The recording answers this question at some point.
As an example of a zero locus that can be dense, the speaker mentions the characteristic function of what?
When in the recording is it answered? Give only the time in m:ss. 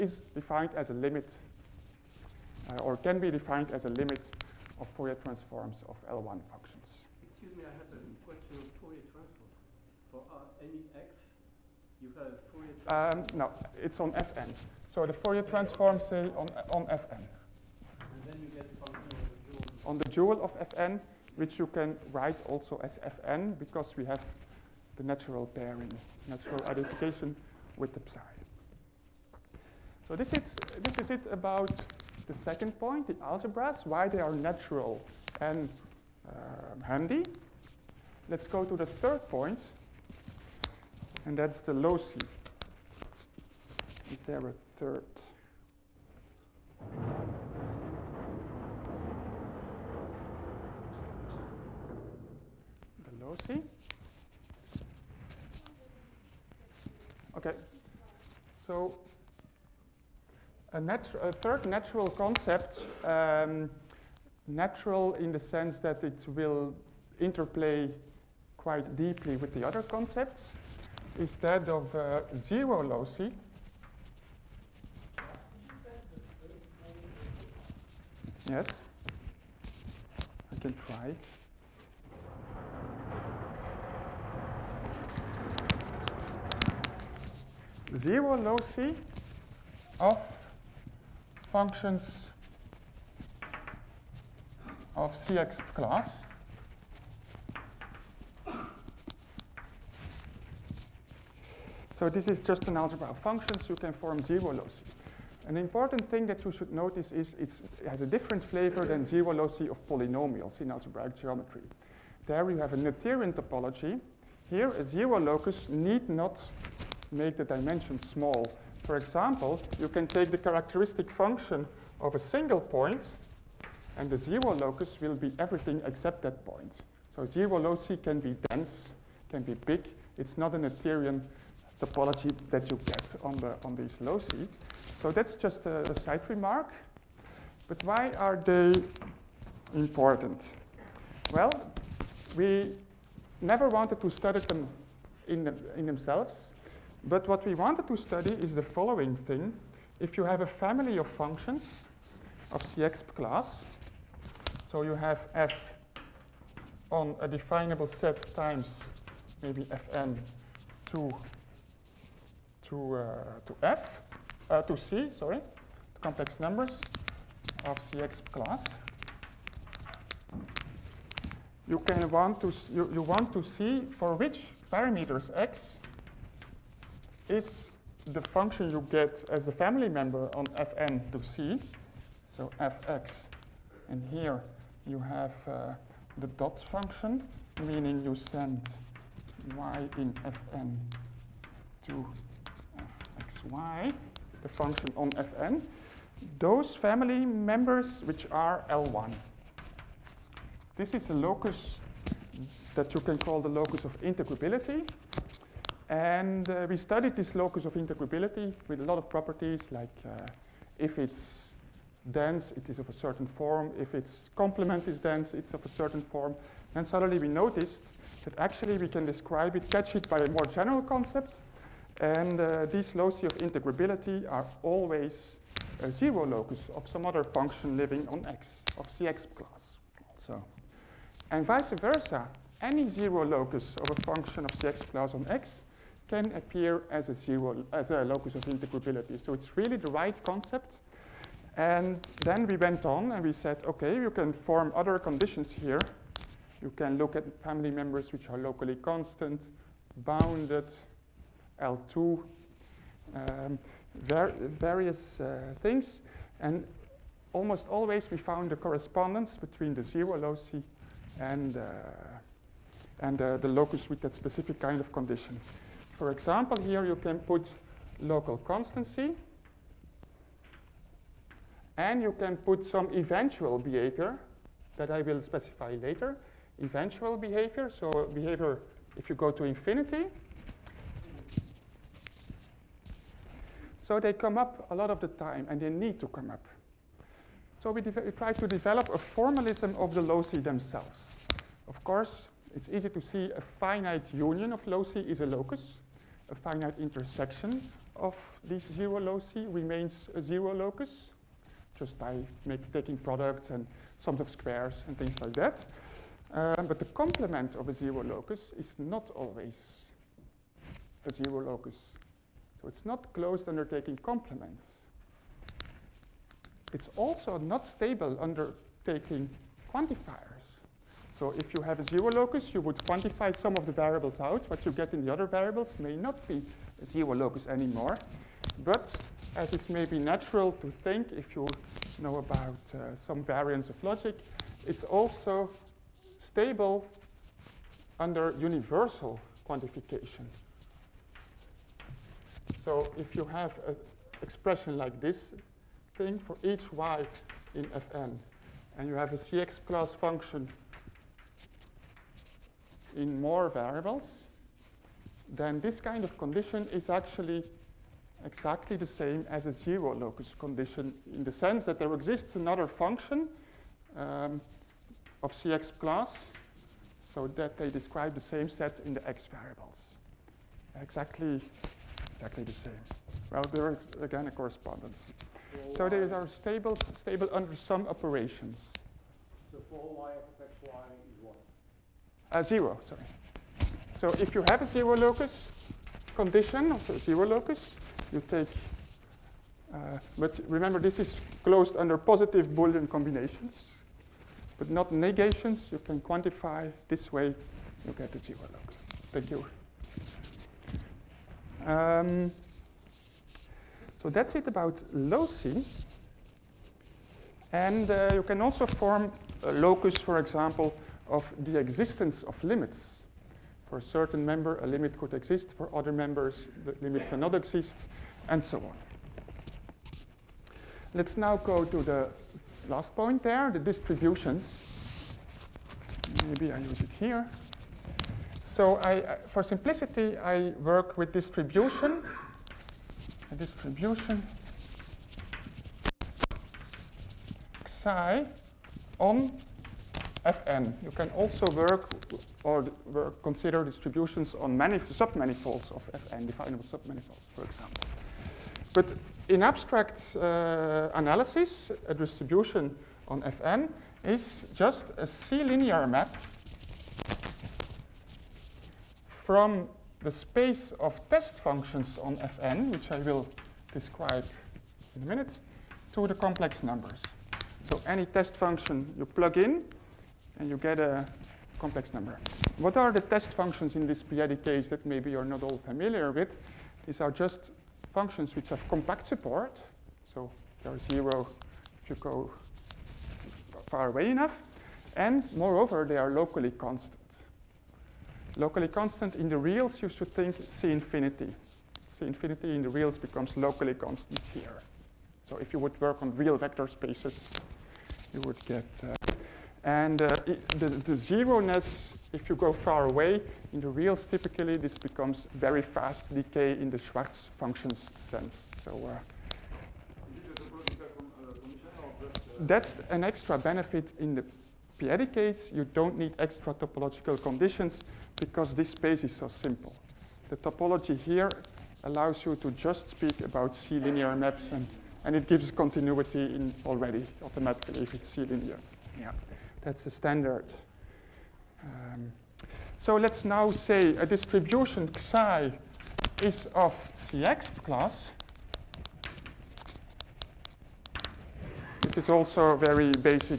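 2:02.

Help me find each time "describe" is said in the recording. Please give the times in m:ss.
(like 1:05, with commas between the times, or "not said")
3:39, 6:07, 7:43.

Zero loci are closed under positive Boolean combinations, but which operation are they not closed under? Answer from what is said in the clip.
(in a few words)
negations.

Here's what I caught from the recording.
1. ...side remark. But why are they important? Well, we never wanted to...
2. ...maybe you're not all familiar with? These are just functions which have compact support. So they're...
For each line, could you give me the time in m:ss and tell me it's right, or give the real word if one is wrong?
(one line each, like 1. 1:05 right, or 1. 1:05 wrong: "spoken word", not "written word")
1. 2:16 right
2. 7:54 right.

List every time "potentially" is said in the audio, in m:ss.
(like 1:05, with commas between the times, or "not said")
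not said.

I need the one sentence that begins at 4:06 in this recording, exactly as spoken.
You can look at family members which are locally constant, bounded, L2, um, var various uh, things.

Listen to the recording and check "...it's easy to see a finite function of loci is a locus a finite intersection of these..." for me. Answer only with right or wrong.
wrong.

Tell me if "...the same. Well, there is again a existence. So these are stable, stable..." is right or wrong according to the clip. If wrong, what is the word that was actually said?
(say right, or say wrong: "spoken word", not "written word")
wrong: "correspondence", not "existence".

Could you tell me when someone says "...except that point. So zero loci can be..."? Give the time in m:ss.
2:05.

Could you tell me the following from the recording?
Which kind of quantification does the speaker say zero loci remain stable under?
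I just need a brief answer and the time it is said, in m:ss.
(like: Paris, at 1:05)
universal quantification, at 5:38.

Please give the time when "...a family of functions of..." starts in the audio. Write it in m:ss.
2:30.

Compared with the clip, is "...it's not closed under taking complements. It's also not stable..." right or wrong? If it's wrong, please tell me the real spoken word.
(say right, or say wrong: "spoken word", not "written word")
right.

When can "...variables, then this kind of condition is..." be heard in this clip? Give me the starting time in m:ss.
5:53.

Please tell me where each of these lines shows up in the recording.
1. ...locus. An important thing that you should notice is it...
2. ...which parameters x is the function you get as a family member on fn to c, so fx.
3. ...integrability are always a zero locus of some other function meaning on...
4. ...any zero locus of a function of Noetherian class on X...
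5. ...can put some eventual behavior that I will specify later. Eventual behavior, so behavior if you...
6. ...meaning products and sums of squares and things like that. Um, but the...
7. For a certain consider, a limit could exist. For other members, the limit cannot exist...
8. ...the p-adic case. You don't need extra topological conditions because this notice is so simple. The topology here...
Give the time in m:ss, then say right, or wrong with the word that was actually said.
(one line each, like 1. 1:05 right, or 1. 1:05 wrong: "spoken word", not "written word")
1. 1:44 right
2. 2:54 right
3. 3:43 wrong: "living", not "meaning"
4. 3:52 wrong: "Cexp", not "Noetherian"
5. 4:32 right
6. 5:02 wrong: "taking", not "meaning"
7. 6:53 wrong: "member", not "consider"
8. 8:34 wrong: "space", not "notice".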